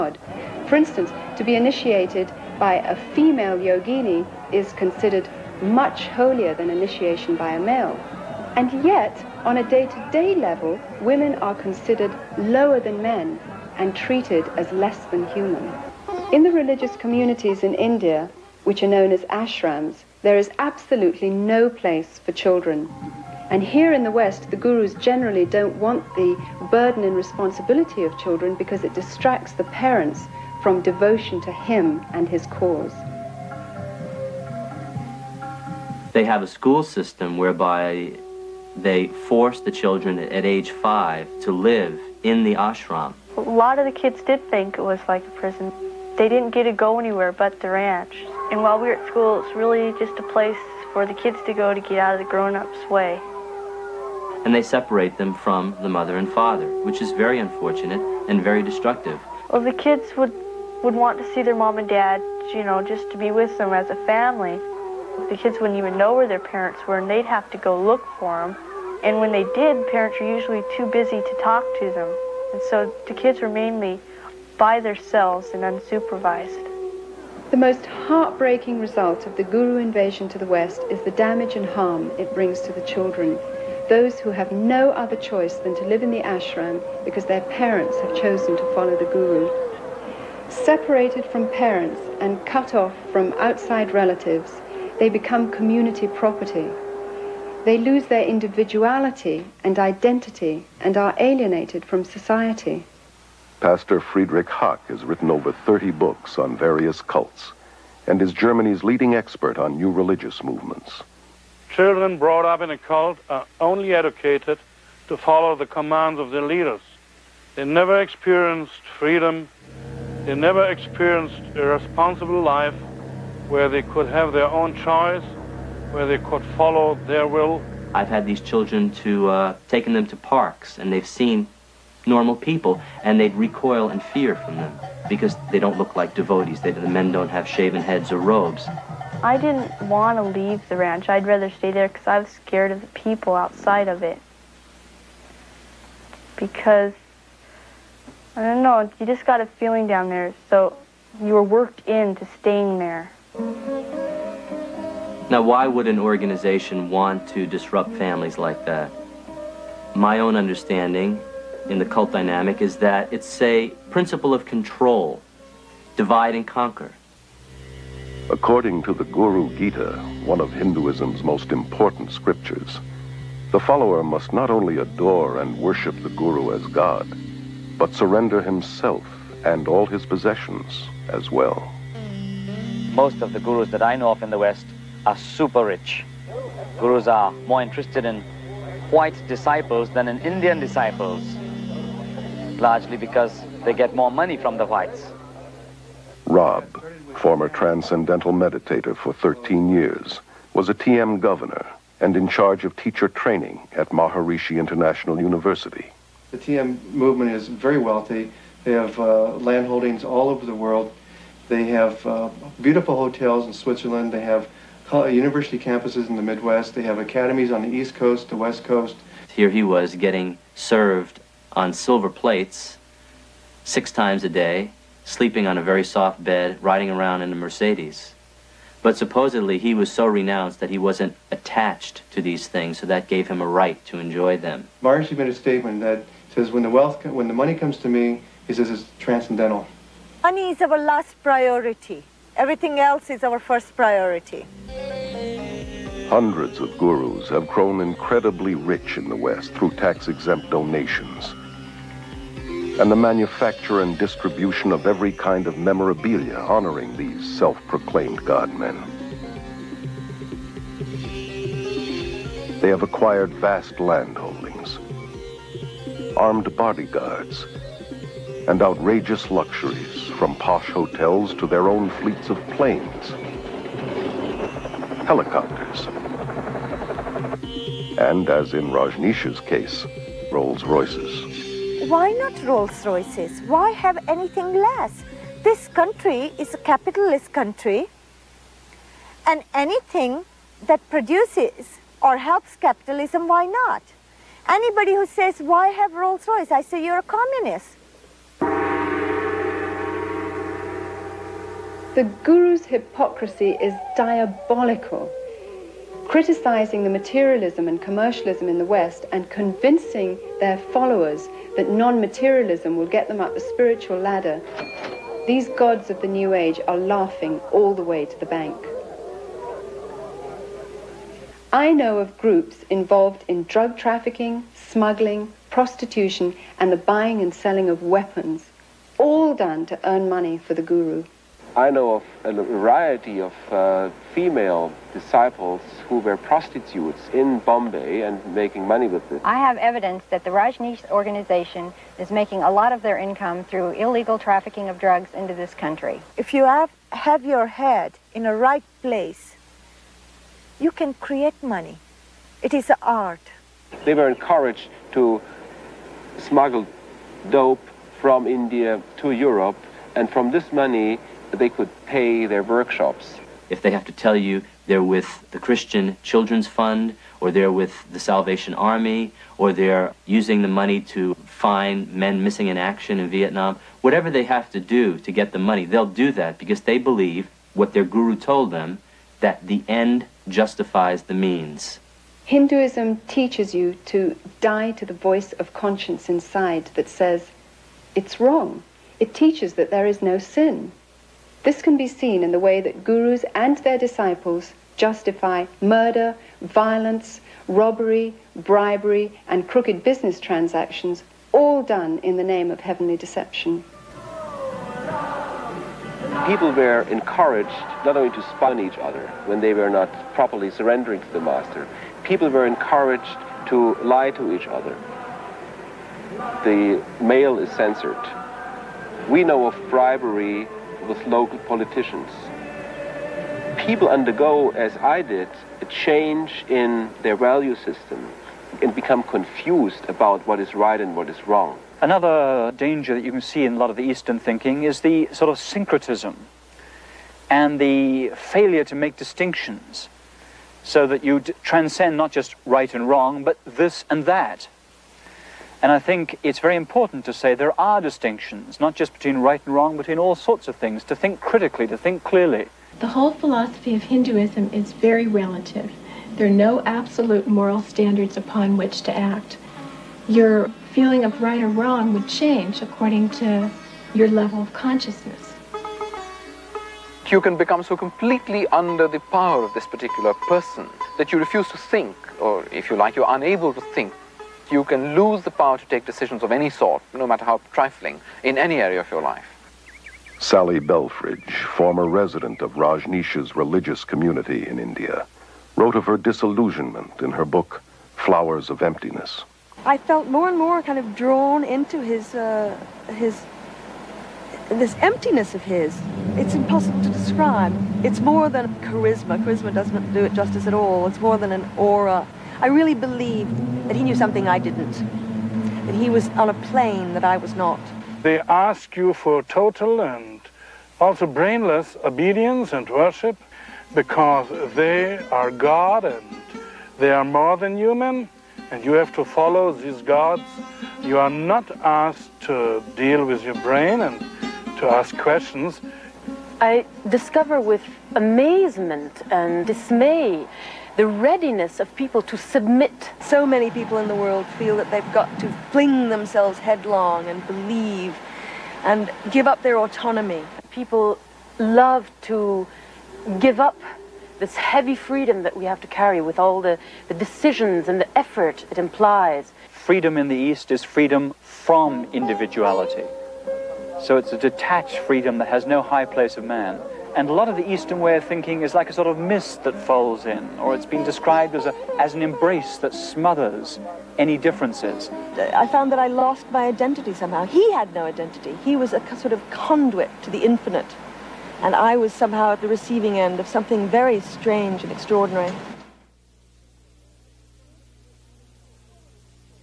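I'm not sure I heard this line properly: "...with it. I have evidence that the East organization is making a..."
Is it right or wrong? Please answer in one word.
wrong.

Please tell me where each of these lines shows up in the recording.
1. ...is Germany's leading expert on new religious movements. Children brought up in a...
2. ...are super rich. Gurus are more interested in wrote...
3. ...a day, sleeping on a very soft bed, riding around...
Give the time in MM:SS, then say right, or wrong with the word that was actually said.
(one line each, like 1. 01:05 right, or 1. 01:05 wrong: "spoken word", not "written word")
1. 01:48 right
2. 03:05 wrong: "white", not "wrote"
3. 03:44 right.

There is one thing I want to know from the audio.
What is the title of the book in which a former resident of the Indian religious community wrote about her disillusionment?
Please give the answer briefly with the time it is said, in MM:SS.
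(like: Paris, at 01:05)
Flowers of Emptiness, at 08:07.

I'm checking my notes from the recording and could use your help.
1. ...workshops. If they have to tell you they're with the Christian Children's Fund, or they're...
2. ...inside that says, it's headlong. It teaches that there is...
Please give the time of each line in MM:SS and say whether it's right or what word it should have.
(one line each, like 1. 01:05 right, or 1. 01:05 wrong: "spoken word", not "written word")
1. 06:02 right
2. 06:26 wrong: "wrong", not "headlong".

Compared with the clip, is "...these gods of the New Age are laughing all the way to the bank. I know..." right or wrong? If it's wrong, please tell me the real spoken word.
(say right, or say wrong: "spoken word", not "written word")
right.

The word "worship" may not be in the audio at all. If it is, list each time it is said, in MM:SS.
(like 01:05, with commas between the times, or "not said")
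02:55, 08:32.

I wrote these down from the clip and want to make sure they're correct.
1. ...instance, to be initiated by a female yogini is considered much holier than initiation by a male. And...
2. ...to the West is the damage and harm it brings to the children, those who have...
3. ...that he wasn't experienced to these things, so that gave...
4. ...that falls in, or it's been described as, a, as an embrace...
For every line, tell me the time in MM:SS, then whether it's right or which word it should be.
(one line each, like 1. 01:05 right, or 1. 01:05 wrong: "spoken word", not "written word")
1. 00:00 right
2. 01:20 right
3. 03:50 wrong: "attached", not "experienced"
4. 09:19 right.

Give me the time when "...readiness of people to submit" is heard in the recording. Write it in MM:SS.
08:50.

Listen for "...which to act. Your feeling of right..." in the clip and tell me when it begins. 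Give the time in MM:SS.
07:38.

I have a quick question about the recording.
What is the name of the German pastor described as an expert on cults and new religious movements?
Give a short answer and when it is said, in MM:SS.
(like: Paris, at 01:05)
Friedrich Haack, at 01:44.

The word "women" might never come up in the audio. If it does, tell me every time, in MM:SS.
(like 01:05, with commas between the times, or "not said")
00:11.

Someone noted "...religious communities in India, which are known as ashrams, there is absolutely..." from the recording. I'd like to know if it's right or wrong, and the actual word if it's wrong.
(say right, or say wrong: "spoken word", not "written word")
right.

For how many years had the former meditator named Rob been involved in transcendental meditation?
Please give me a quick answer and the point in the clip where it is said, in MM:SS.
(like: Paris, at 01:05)
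13, at 03:19.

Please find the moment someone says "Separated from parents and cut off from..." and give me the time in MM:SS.
01:30.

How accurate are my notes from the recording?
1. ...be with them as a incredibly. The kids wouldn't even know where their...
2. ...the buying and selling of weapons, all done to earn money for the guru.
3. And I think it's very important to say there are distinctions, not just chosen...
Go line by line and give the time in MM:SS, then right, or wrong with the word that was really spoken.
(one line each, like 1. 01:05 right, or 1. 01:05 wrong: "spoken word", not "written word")
1. 01:03 wrong: "family", not "incredibly"
2. 05:26 right
3. 07:25 wrong: "between", not "chosen".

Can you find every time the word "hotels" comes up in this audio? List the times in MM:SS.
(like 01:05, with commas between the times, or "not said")
03:32, 04:30.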